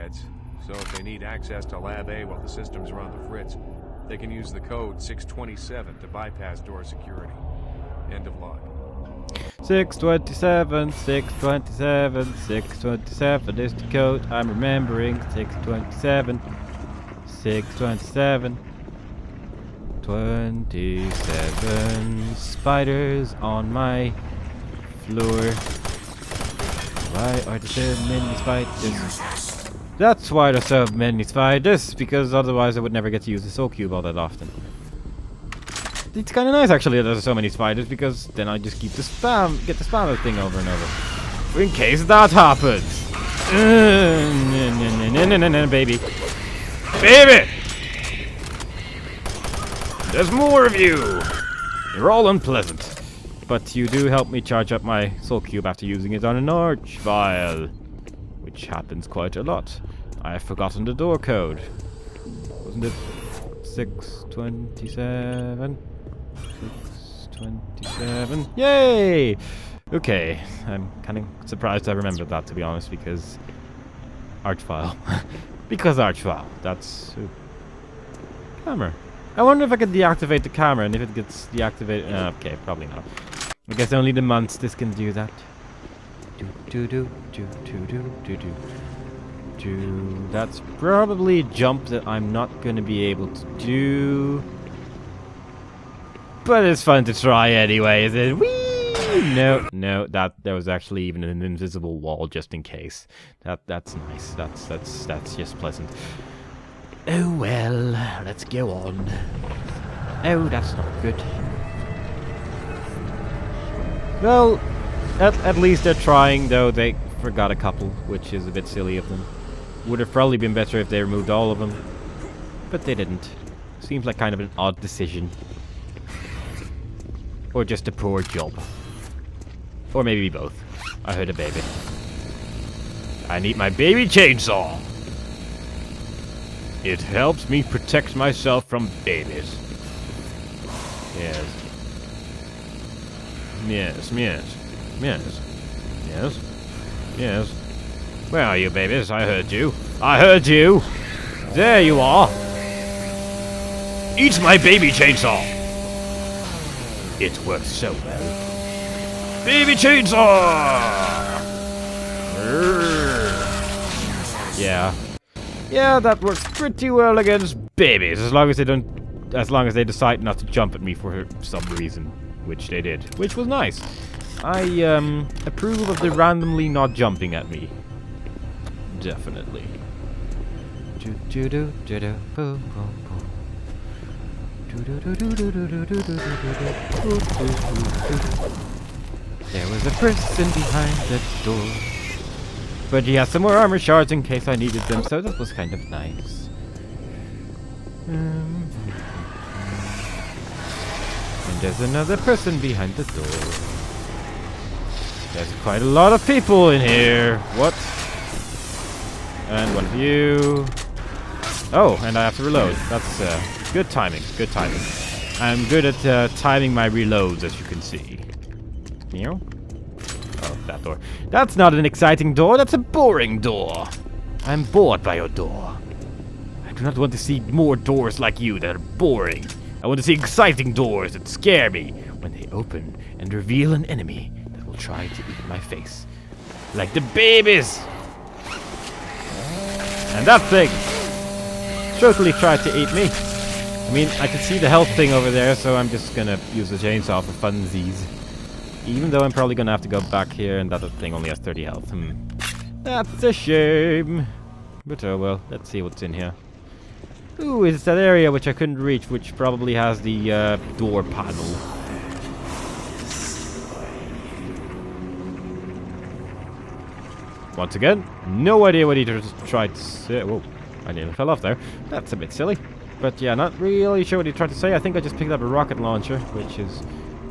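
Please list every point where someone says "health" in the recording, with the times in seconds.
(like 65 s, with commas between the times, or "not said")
244 s, 251 s.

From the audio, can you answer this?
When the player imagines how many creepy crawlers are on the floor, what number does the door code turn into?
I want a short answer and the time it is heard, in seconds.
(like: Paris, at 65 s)
27, at 20 s.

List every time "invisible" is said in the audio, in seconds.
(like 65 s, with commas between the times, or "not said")
101 s.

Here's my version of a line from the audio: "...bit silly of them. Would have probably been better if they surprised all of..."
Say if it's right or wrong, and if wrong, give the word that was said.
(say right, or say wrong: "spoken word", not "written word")
wrong: "removed", not "surprised".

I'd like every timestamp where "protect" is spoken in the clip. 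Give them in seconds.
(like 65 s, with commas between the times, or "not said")
137 s.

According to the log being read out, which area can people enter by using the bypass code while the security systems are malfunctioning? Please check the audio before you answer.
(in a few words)
Lab A.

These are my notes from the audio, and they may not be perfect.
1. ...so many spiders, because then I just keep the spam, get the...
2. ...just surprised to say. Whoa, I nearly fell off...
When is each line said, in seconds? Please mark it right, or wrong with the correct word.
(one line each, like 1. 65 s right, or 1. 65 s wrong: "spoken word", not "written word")
1. 37 s right
2. 269 s wrong: "tried", not "surprised".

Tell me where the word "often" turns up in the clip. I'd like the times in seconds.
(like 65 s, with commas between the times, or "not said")
34 s.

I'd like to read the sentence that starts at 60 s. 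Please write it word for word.
I have forgotten the door code.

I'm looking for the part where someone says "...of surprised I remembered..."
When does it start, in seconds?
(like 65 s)
71 s.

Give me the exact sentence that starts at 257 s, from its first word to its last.
Ooh, it's that area which I couldn't reach, which probably has the uh, door panel.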